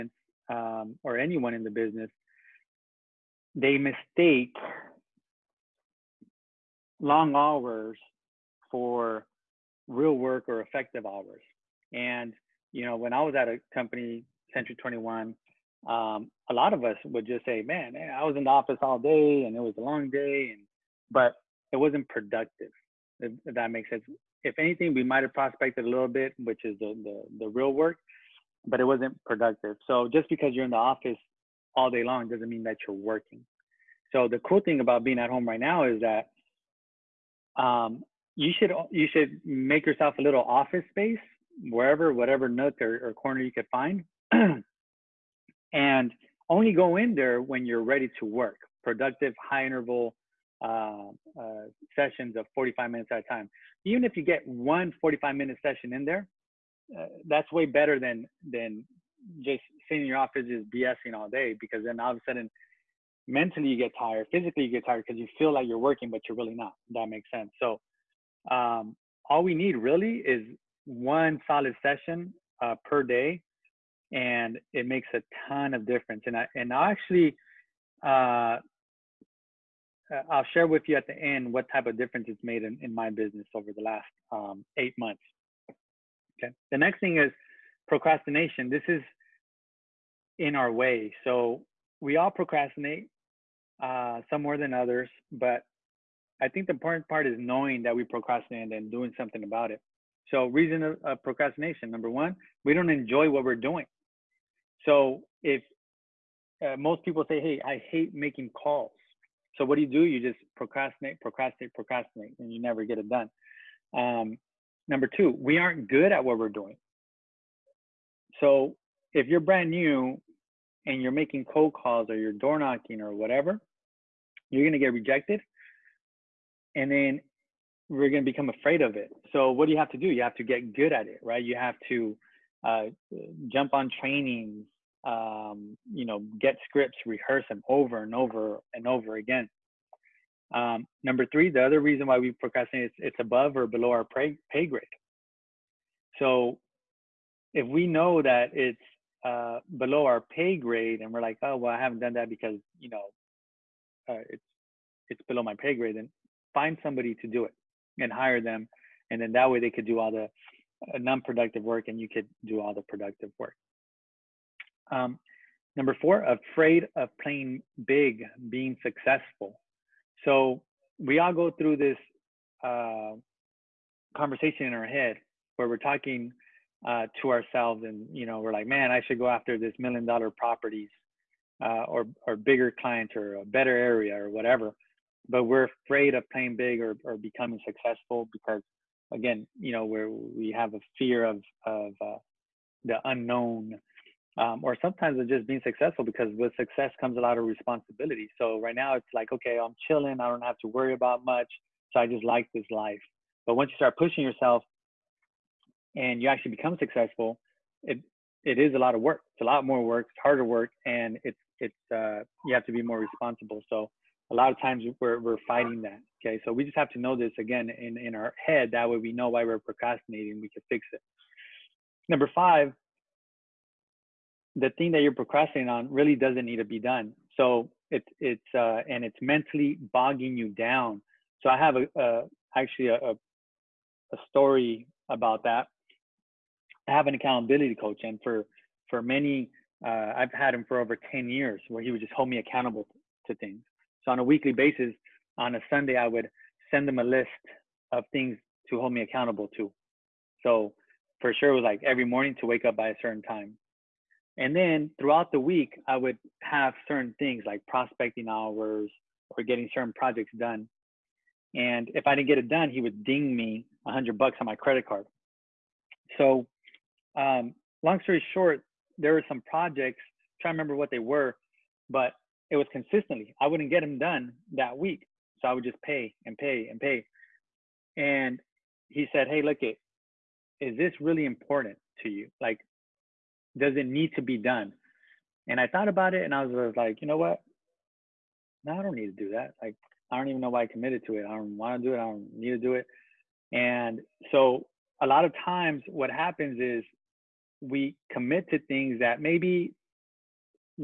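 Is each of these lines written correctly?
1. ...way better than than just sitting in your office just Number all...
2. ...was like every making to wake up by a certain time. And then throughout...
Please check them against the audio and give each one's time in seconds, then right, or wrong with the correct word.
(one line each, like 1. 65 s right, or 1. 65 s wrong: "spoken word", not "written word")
1. 57 s wrong: "BSing", not "Number"
2. 251 s wrong: "morning", not "making".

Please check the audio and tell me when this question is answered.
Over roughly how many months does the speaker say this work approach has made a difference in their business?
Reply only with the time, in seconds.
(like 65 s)
84 s.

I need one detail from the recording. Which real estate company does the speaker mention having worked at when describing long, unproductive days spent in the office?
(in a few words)
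Century 21.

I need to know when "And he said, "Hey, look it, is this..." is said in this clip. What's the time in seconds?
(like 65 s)
277 s.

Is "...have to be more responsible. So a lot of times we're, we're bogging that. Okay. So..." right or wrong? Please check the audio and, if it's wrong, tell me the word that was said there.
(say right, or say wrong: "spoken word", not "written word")
wrong: "fighting", not "bogging".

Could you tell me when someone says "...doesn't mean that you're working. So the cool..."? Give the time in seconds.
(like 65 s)
32 s.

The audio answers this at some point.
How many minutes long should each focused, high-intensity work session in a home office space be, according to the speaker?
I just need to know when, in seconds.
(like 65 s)
52 s.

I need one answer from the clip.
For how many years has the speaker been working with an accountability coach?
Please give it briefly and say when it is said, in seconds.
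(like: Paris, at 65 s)
Over 10 years, at 240 s.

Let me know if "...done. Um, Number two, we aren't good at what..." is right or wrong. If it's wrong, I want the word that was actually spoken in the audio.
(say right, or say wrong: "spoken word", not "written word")
right.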